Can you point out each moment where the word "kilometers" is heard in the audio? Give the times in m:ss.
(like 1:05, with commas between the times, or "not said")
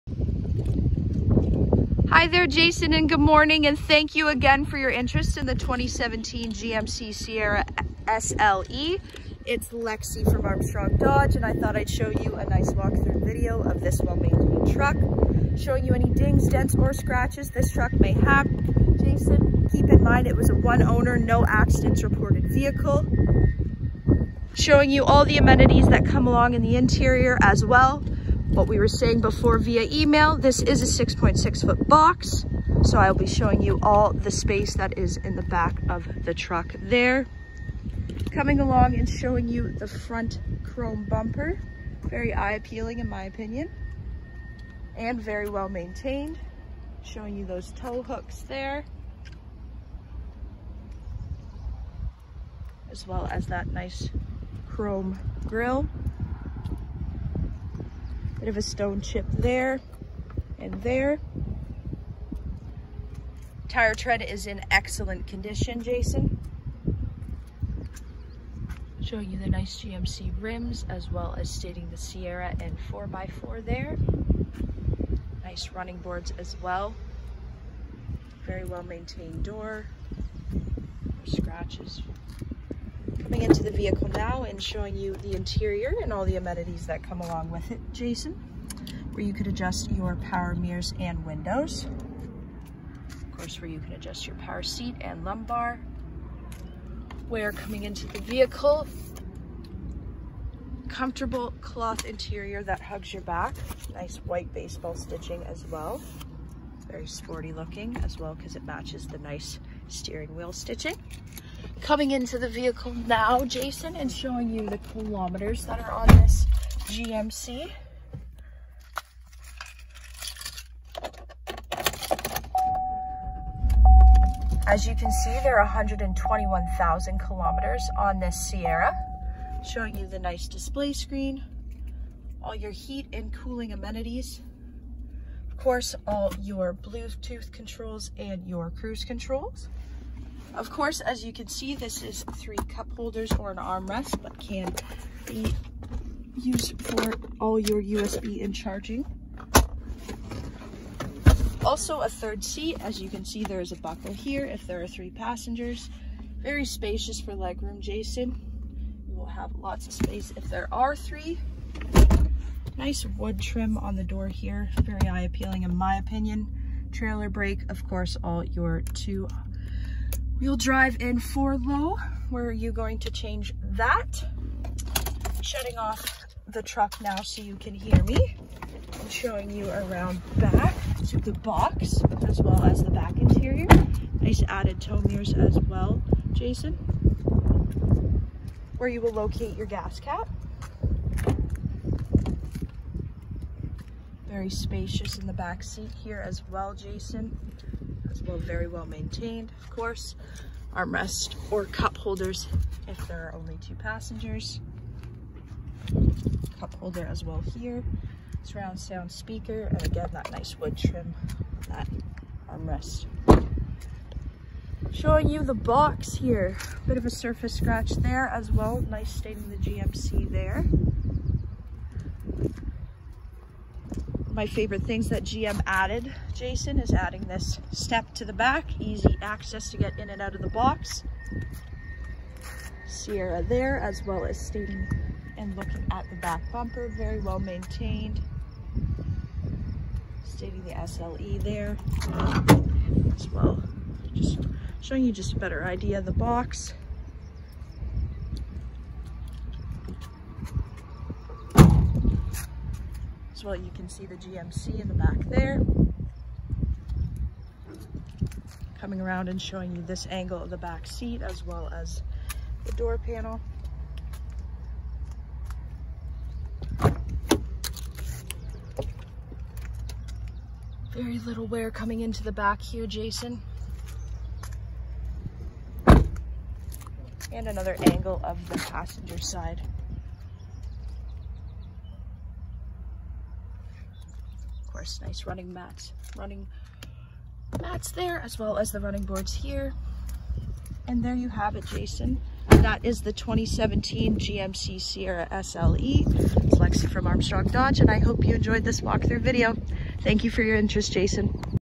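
1:54, 2:07.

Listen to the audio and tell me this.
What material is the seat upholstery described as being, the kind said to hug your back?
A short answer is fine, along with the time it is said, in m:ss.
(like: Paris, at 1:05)
Cloth, at 1:41.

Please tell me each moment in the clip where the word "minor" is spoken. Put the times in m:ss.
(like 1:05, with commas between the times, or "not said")
not said.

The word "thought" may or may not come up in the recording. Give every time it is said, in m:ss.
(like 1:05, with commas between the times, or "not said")
0:11.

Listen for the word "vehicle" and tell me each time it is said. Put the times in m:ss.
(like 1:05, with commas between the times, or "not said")
0:22, 1:23, 1:38, 1:52.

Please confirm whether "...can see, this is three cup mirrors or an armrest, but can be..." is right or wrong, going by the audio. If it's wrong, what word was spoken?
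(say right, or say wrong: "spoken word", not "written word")
wrong: "holders", not "mirrors".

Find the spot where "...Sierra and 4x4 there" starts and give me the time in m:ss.
1:11.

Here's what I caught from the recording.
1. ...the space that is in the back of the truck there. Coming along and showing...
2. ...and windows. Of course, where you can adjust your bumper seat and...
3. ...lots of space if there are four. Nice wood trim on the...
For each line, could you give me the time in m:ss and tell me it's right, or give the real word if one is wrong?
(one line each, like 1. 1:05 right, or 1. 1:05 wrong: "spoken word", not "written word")
1. 0:34 right
2. 1:30 wrong: "power", not "bumper"
3. 2:39 wrong: "three", not "four".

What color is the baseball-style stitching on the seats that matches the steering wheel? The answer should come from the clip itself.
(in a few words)
White.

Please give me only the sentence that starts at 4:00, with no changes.
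Stating the SLE there as well.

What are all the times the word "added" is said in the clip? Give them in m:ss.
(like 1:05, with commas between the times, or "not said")
3:04, 3:45.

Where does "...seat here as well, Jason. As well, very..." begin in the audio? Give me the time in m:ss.
3:15.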